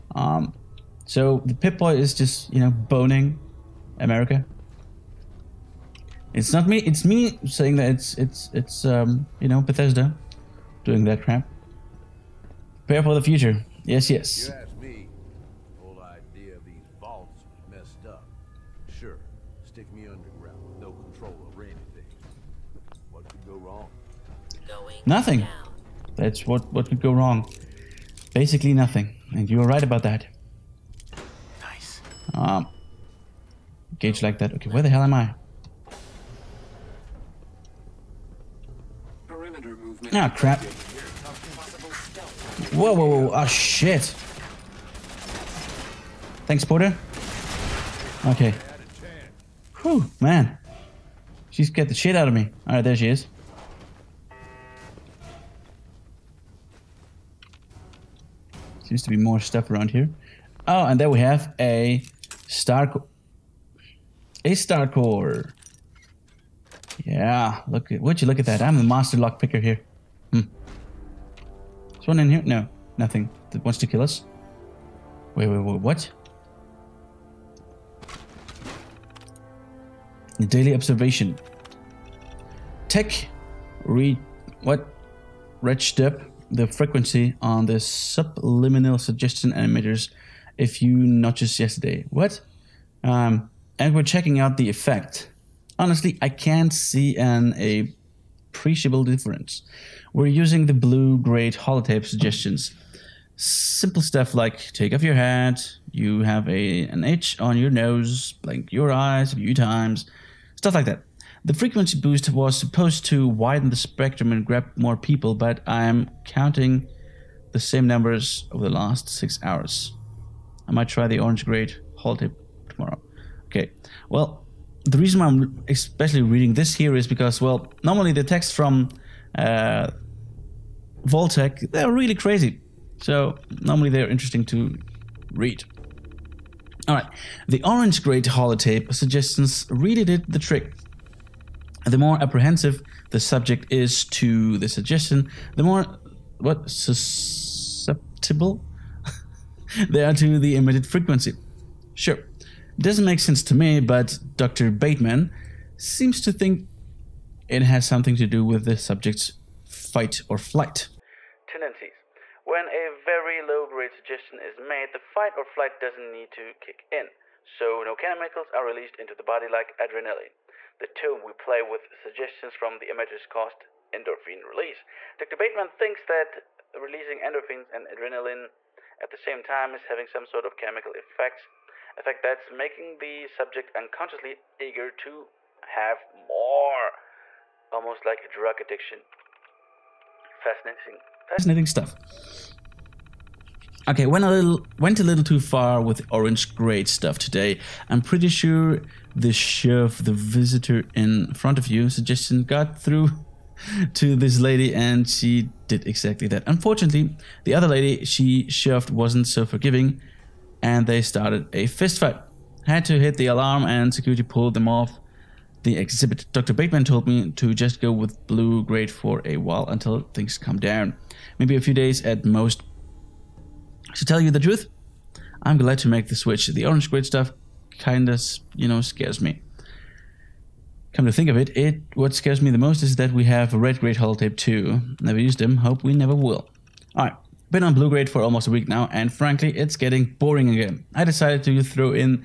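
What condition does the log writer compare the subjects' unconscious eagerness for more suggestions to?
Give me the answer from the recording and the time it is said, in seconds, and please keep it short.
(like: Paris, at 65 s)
a drug addiction, at 188 s.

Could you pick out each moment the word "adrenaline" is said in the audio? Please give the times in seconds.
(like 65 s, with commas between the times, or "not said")
169 s, 177 s.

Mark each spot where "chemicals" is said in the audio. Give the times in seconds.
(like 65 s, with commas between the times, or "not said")
167 s, 180 s.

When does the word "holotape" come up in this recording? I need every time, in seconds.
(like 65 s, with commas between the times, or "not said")
101 s, 121 s, 138 s, 234 s.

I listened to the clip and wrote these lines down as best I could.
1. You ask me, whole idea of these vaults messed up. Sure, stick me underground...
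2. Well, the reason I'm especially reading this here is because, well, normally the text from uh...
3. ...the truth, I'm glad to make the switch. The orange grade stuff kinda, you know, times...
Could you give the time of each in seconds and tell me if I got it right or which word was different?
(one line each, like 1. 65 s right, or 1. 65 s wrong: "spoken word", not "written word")
1. 14 s right
2. 124 s right
3. 224 s wrong: "scares", not "times".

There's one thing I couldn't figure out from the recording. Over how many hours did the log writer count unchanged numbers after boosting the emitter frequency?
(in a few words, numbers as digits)
6.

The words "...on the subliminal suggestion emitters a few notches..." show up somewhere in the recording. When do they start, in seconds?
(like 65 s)
87 s.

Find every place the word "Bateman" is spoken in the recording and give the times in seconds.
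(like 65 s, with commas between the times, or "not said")
154 s, 175 s, 216 s.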